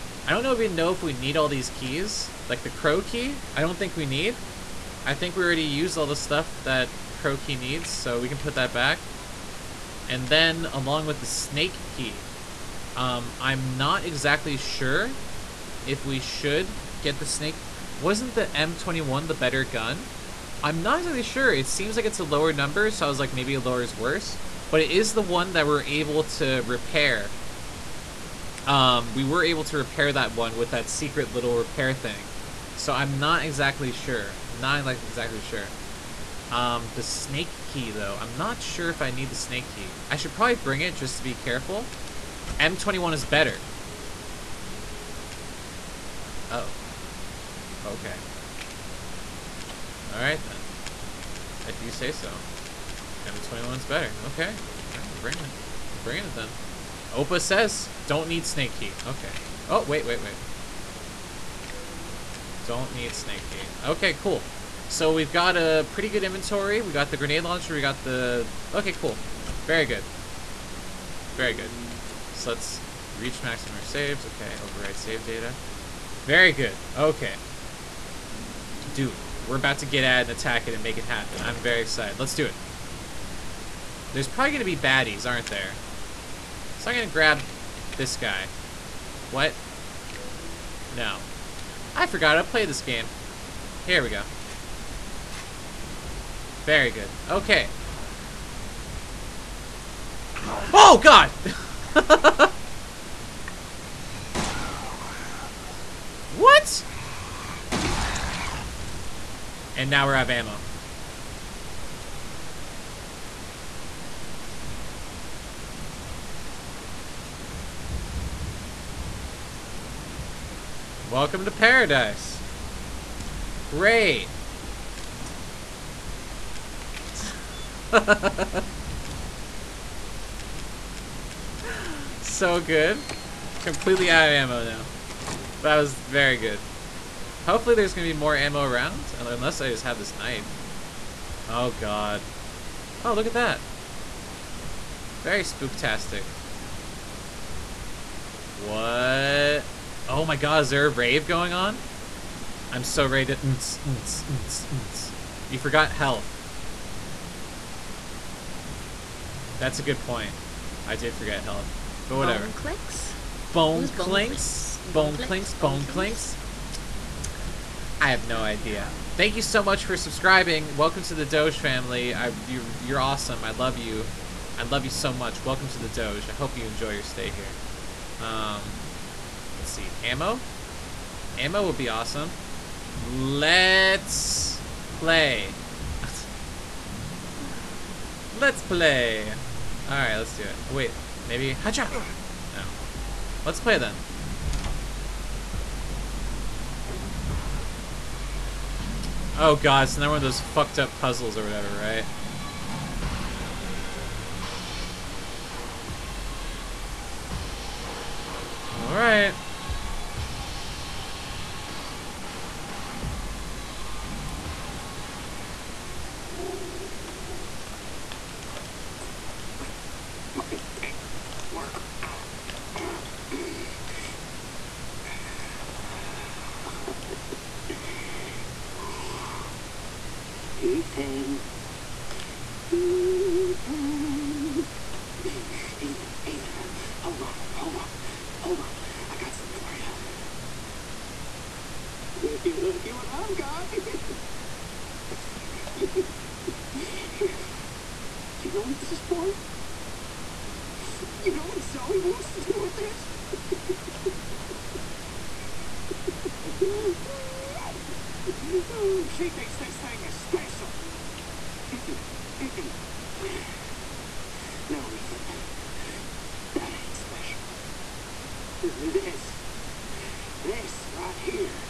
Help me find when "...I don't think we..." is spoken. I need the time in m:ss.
0:03.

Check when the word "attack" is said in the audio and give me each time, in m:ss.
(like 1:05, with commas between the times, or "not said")
1:20.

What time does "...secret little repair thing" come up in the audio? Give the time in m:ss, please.
0:30.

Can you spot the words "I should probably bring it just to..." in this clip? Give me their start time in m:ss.
0:40.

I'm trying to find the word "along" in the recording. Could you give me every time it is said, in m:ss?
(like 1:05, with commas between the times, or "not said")
0:10.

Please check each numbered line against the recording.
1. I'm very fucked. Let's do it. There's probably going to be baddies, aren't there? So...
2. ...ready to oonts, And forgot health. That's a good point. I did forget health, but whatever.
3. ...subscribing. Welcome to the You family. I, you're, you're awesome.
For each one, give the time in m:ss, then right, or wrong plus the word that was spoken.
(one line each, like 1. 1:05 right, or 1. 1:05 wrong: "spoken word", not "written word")
1. 1:21 wrong: "excited", not "fucked"
2. 2:33 wrong: "You", not "And"
3. 2:49 wrong: "Doge", not "You".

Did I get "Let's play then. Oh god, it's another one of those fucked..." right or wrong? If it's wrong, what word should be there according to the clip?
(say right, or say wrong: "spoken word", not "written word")
right.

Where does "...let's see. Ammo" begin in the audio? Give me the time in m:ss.
2:59.